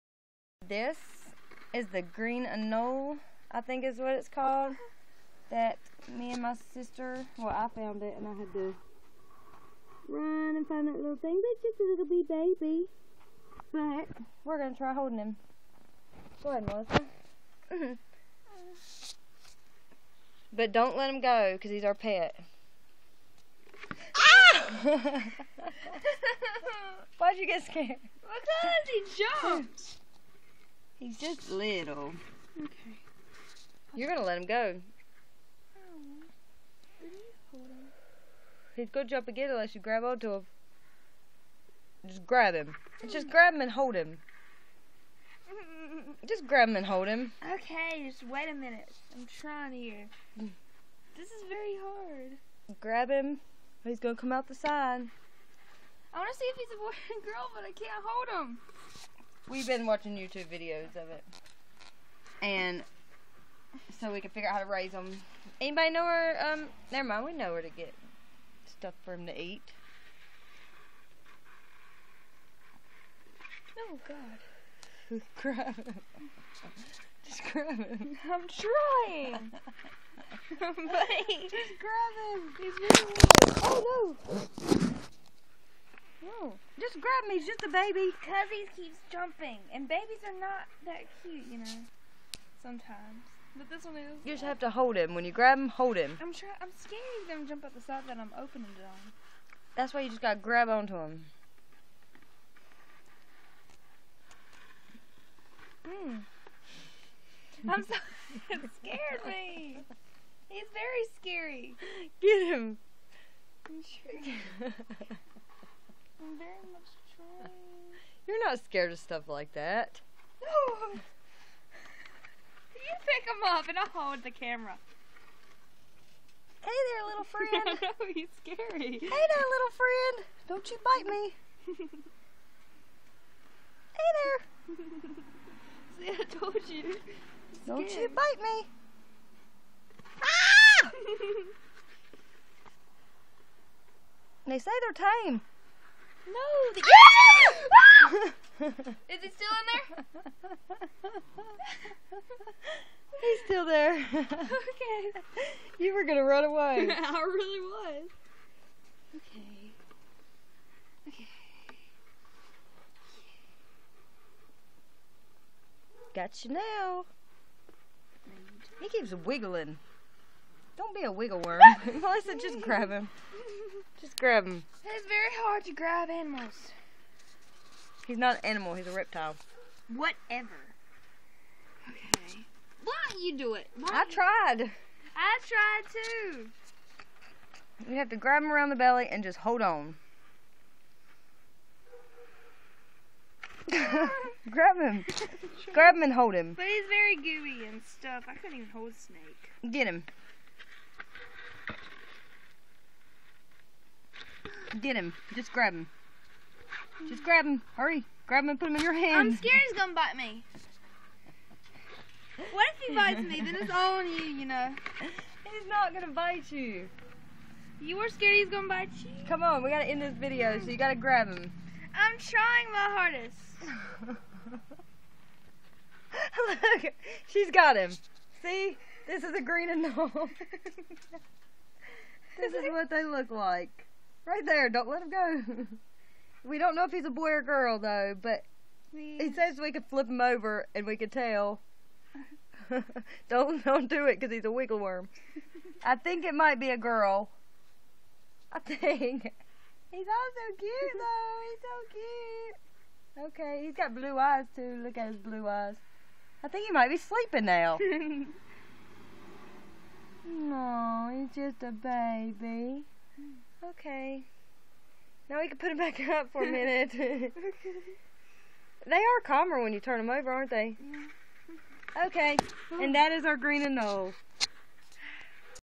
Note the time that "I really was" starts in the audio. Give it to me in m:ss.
2:36.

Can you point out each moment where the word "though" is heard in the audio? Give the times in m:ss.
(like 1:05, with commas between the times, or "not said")
3:57, 4:10.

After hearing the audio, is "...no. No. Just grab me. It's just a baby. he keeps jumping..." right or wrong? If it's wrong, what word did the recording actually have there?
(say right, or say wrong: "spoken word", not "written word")
right.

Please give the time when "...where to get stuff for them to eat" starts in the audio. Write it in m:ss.
1:07.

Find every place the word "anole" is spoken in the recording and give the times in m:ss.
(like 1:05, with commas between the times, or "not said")
0:02, 4:33.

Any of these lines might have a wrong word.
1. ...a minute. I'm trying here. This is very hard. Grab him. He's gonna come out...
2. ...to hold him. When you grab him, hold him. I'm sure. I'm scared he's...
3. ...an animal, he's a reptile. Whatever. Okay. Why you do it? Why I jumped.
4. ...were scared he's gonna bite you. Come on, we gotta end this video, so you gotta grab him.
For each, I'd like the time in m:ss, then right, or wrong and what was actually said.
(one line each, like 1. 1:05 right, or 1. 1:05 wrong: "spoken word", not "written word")
1. 0:48 right
2. 1:34 right
3. 2:58 wrong: "tried", not "jumped"
4. 3:37 right.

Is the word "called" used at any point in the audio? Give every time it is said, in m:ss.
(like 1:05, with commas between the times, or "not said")
0:04.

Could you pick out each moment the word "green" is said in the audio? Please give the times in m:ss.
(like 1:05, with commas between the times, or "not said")
0:02, 3:49, 4:33.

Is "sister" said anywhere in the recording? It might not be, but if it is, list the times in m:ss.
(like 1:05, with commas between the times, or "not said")
0:06.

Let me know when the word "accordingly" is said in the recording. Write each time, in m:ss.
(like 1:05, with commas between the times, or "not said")
not said.